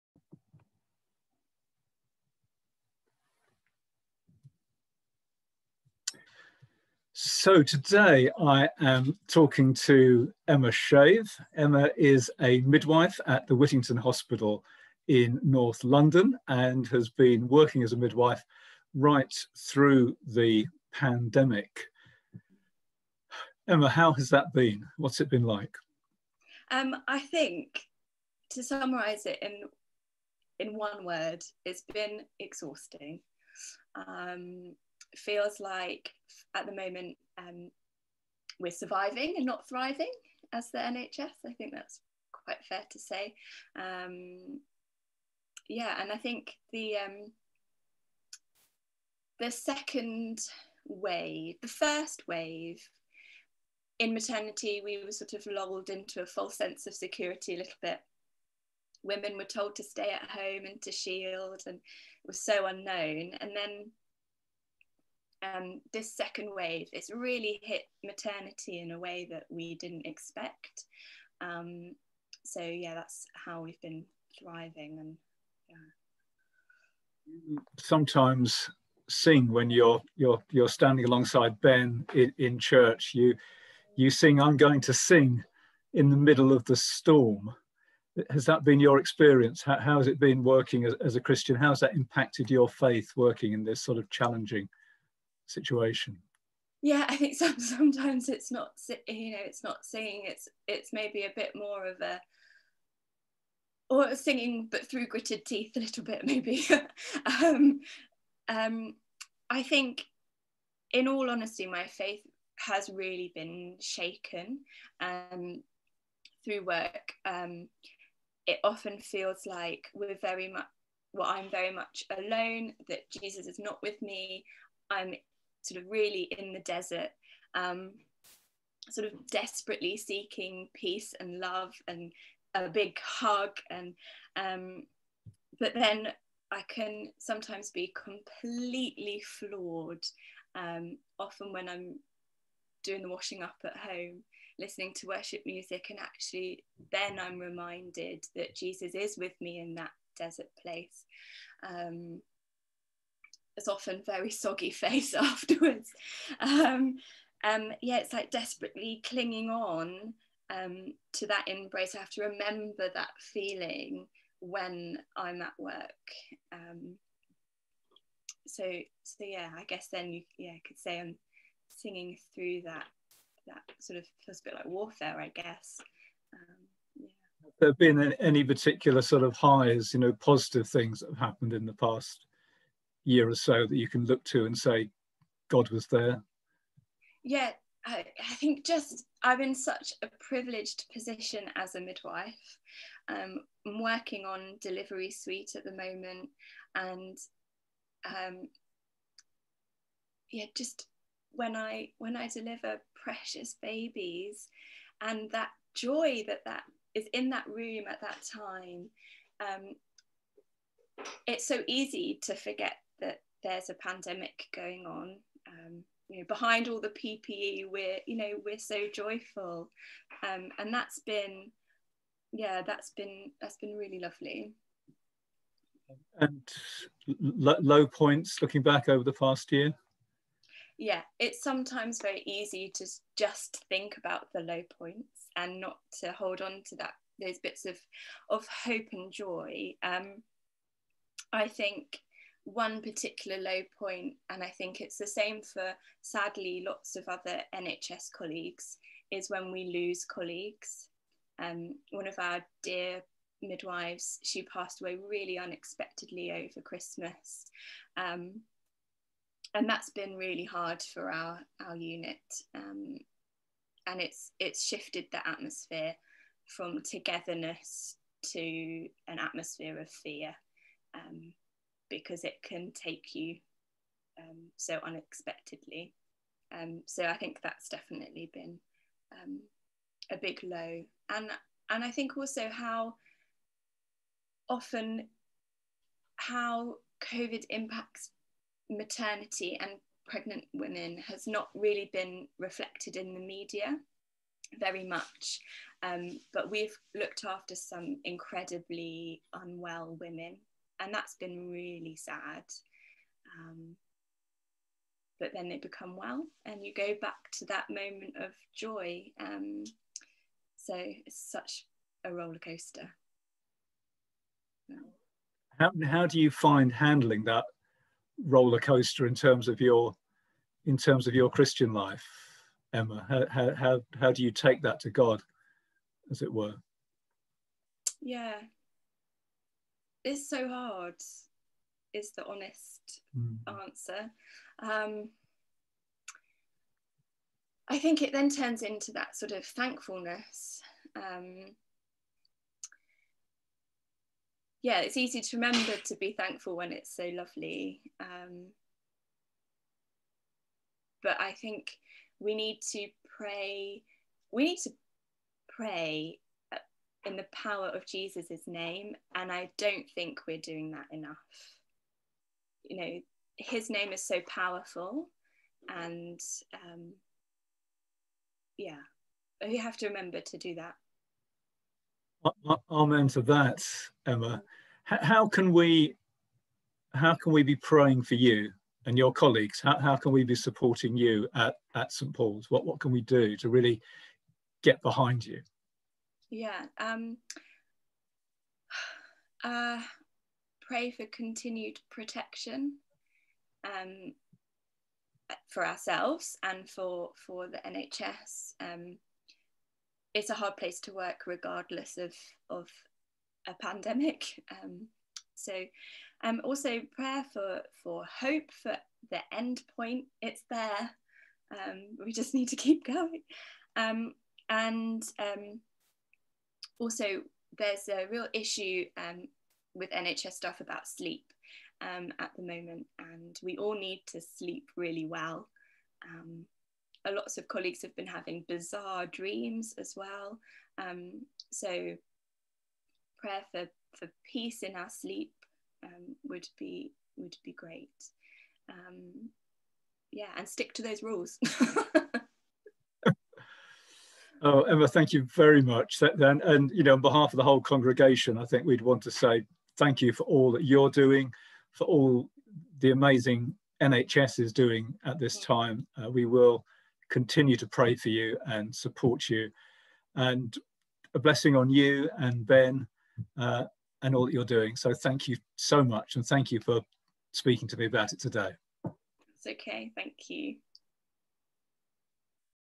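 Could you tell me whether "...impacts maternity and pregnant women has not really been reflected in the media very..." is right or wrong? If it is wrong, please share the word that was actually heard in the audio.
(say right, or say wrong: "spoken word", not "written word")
right.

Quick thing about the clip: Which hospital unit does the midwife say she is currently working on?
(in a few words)
Delivery suite.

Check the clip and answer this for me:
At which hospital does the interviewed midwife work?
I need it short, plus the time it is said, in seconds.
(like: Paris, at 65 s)
Whittington Hospital, at 13 s.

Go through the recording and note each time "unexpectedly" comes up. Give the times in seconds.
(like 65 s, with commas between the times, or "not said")
255 s, 274 s.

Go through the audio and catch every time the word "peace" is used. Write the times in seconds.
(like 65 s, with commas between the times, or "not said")
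130 s, 434 s.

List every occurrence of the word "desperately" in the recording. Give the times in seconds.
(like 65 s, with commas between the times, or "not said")
129 s, 158 s.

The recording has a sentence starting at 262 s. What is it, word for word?
Um, and it's, it's shifted the atmosphere from togetherness to an atmosphere of fear.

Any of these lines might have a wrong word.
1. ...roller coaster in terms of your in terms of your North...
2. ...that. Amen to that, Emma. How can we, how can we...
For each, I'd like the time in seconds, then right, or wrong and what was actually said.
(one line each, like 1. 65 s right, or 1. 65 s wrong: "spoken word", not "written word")
1. 318 s wrong: "Christian", not "North"
2. 370 s right.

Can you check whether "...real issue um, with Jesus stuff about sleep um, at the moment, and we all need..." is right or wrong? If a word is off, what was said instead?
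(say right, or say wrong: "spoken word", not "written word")
wrong: "NHS", not "Jesus".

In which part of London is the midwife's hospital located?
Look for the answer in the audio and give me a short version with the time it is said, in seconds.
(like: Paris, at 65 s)
North London, at 15 s.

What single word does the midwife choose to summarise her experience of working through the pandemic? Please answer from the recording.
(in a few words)
Exhausting.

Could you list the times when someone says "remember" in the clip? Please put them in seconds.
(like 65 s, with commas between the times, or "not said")
162 s, 345 s, 369 s.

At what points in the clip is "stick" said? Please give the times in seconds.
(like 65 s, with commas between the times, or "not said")
440 s.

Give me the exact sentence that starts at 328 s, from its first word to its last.
Yeah, is so hard, is the honest mm.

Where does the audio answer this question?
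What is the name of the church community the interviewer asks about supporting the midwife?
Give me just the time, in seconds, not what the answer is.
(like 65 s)
381 s.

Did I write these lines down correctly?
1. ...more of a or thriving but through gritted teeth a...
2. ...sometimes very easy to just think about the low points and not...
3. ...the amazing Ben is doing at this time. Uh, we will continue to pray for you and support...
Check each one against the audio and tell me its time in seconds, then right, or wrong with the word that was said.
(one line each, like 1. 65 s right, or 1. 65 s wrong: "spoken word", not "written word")
1. 101 s wrong: "singing", not "thriving"
2. 231 s right
3. 452 s wrong: "NHS", not "Ben".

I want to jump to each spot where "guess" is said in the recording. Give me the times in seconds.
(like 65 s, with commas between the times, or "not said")
169 s, 175 s.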